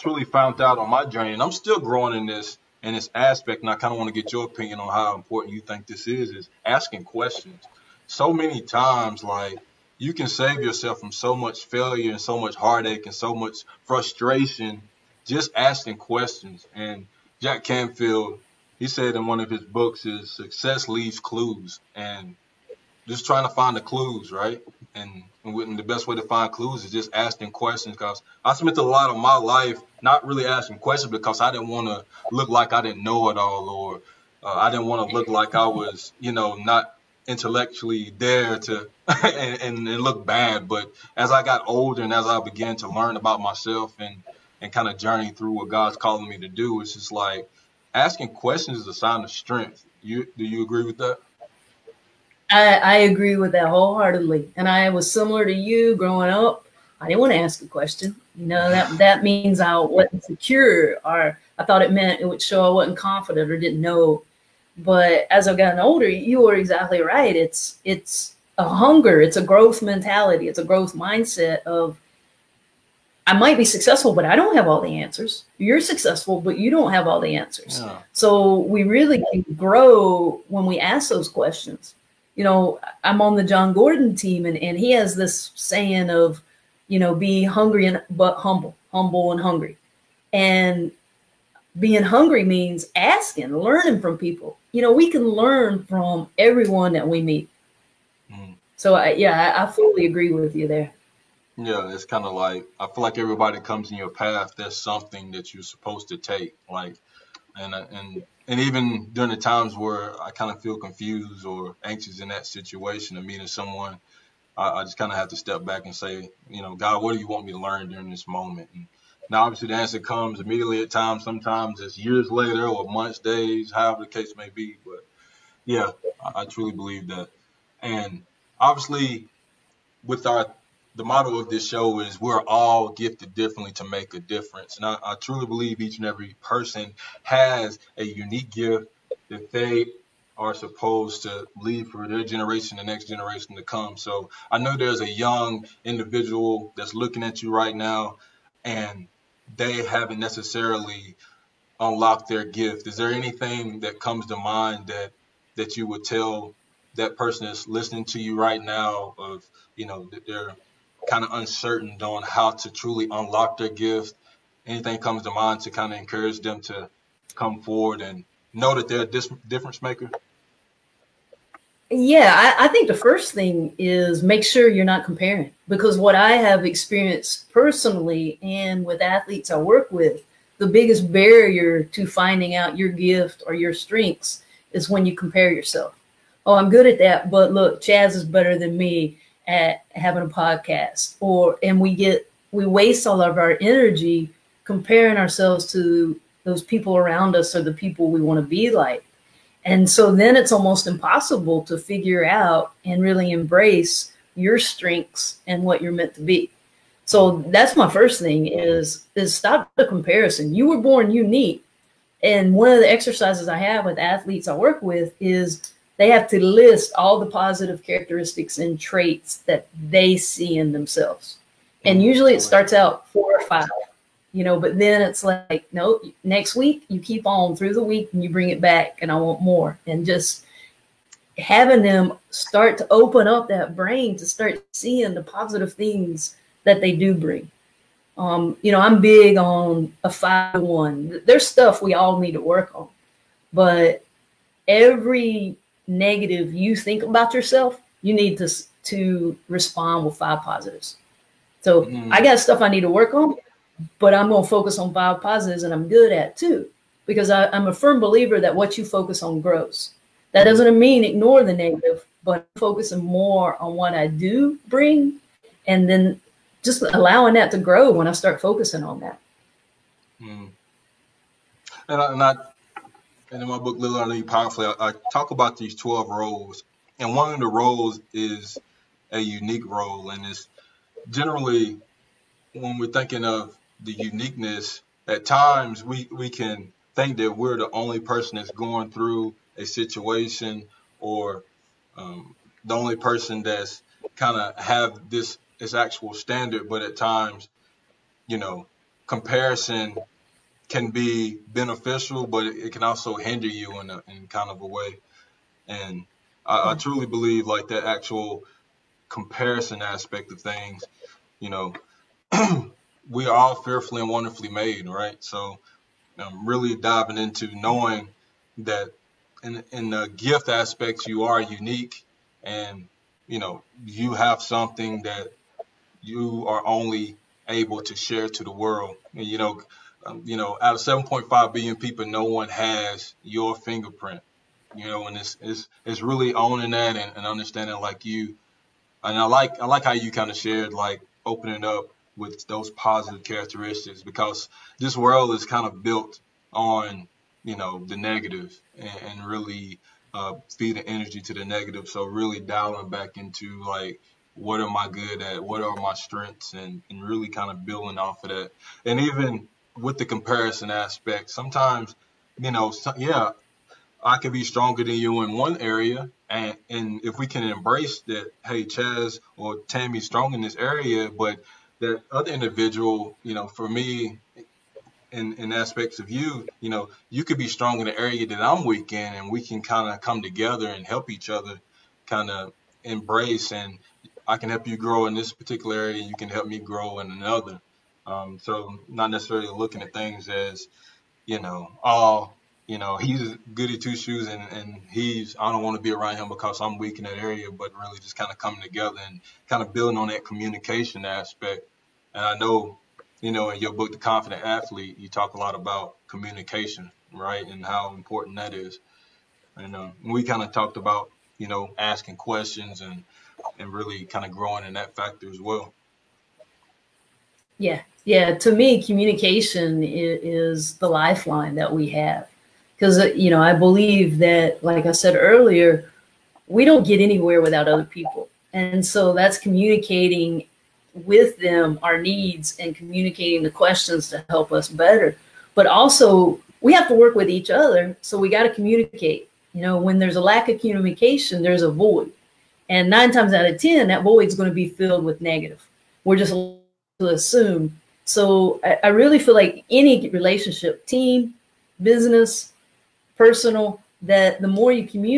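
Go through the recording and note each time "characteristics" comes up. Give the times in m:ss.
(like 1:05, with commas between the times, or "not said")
3:37, 5:43.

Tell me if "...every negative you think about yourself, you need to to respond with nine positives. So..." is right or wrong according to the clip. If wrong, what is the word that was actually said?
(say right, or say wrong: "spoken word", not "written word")
wrong: "five", not "nine".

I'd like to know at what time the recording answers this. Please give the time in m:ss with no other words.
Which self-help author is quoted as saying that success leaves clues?
0:17.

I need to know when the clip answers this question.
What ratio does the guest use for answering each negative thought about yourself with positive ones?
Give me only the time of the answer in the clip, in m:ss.
4:00.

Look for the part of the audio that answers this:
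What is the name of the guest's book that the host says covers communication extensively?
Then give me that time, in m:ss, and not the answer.
6:43.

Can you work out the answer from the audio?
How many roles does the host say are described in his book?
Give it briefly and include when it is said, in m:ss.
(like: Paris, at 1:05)
12, at 4:35.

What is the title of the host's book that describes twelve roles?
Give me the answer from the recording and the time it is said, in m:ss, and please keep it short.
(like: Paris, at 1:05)
Little Lead Powerfully, at 4:33.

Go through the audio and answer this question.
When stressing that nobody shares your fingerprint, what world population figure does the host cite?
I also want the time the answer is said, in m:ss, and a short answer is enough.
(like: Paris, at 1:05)
7.5 billion, at 5:30.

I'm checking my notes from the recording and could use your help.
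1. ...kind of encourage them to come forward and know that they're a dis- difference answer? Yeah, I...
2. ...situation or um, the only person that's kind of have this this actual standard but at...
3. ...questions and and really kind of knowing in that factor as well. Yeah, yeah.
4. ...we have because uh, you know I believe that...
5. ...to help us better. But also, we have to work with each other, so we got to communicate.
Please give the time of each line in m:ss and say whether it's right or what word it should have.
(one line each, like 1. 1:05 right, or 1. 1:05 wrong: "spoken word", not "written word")
1. 2:45 wrong: "maker", not "answer"
2. 4:49 right
3. 6:52 wrong: "growing", not "knowing"
4. 7:01 right
5. 7:14 right.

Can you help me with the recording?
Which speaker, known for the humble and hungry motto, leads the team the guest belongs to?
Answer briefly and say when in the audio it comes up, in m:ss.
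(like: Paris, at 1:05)
Jon Gordon, at 1:23.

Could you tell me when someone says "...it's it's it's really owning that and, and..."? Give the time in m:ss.
5:35.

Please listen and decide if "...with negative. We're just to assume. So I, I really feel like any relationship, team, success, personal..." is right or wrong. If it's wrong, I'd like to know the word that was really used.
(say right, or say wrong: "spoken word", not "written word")
wrong: "business", not "success".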